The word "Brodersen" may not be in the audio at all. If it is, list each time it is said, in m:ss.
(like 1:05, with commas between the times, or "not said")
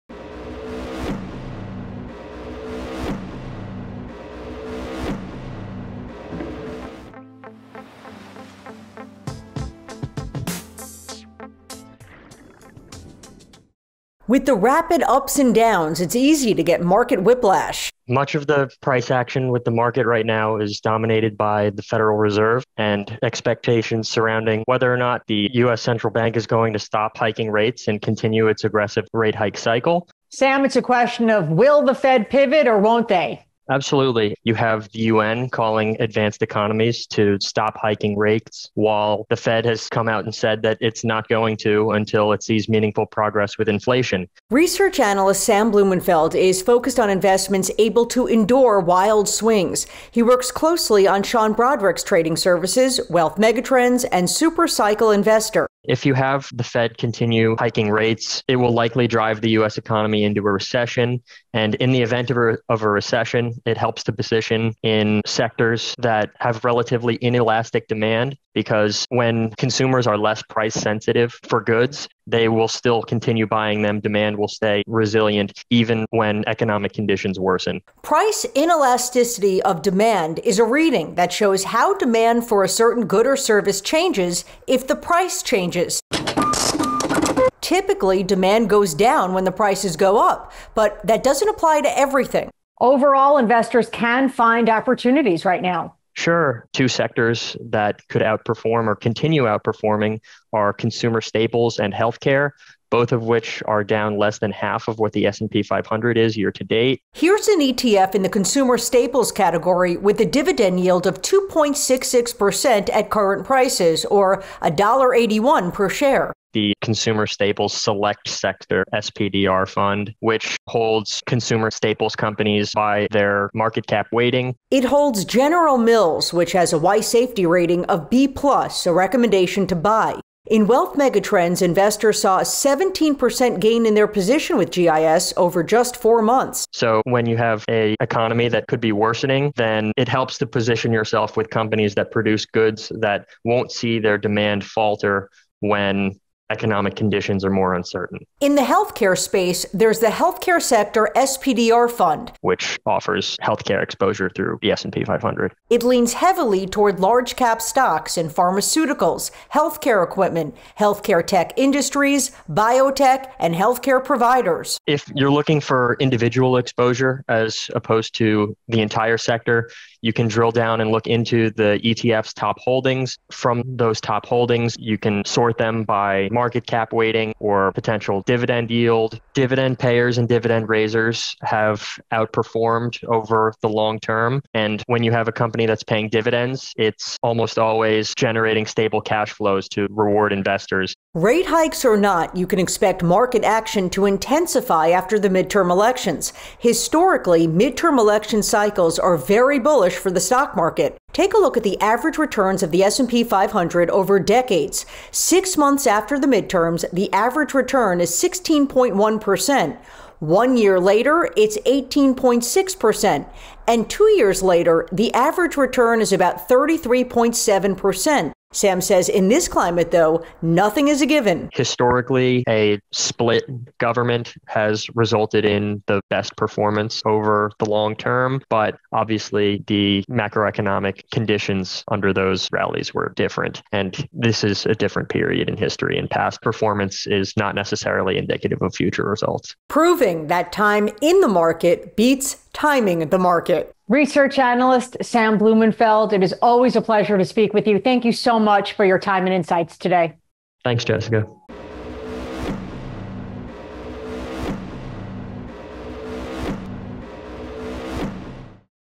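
0:51.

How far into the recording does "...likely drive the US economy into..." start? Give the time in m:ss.
0:58.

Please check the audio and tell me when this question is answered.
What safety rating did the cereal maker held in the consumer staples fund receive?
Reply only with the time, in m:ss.
2:08.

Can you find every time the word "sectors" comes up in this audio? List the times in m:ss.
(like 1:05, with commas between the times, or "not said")
1:05, 1:36, 1:58, 2:30, 2:49.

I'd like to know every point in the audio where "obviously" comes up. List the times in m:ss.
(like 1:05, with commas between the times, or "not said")
3:48.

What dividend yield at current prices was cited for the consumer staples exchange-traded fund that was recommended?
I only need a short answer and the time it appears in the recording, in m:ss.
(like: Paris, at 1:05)
2.66%, at 1:51.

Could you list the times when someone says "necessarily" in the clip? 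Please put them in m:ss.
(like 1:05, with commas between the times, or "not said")
3:57.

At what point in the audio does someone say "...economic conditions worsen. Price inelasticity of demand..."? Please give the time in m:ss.
1:16.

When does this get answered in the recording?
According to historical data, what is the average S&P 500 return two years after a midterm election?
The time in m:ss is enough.
3:36.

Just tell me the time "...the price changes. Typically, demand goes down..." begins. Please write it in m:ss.
1:24.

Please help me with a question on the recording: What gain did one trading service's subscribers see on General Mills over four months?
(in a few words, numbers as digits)
17%.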